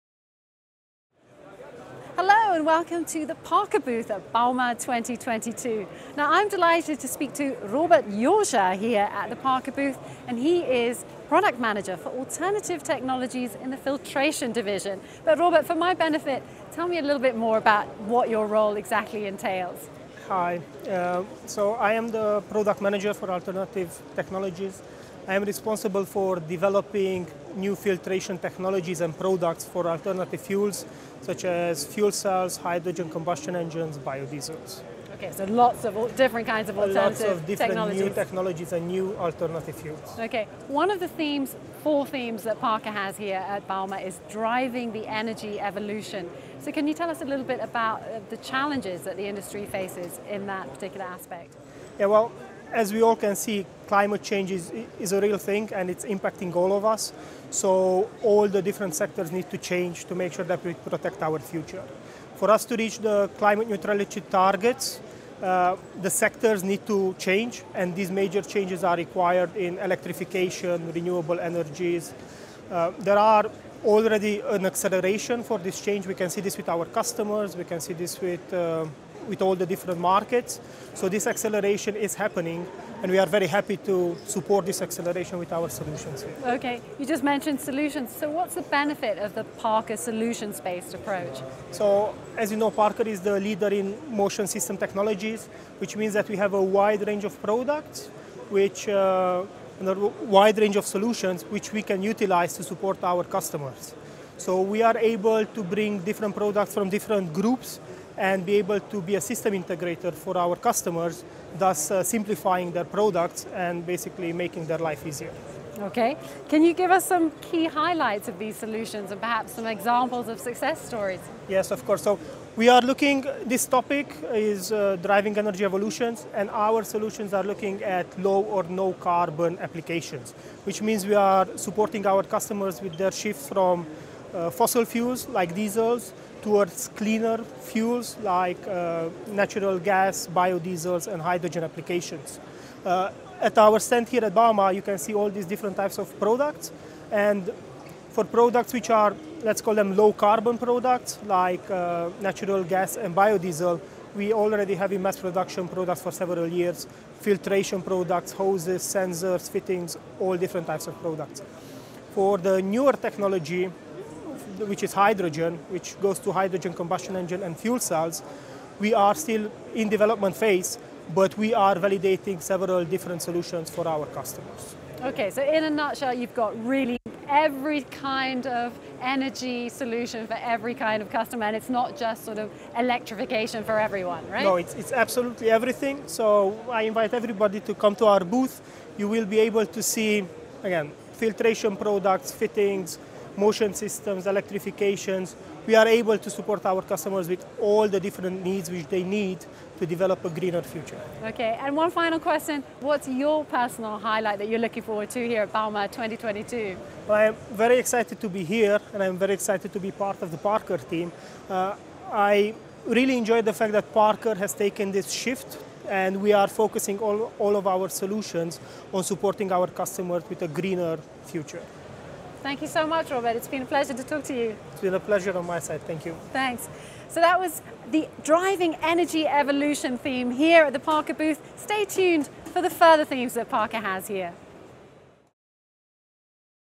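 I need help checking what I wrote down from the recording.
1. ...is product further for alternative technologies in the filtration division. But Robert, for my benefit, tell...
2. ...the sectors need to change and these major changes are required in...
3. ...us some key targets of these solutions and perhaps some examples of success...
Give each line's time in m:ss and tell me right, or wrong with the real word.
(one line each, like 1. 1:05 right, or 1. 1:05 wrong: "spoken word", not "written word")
1. 0:10 wrong: "manager", not "further"
2. 1:06 right
3. 1:56 wrong: "highlights", not "targets".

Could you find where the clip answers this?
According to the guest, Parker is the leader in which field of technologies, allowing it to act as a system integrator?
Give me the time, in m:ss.
1:34.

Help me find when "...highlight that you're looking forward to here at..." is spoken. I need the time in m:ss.
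3:23.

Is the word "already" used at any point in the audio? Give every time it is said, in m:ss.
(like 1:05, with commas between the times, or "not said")
1:13, 2:34.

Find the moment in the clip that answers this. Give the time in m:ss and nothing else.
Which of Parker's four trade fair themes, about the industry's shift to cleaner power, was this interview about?
0:44.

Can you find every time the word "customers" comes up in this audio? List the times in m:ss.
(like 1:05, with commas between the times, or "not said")
1:16, 1:43, 1:50, 2:12, 2:54, 3:01, 3:16, 3:39.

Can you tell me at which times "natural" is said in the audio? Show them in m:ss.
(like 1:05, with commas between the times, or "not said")
2:19, 2:32.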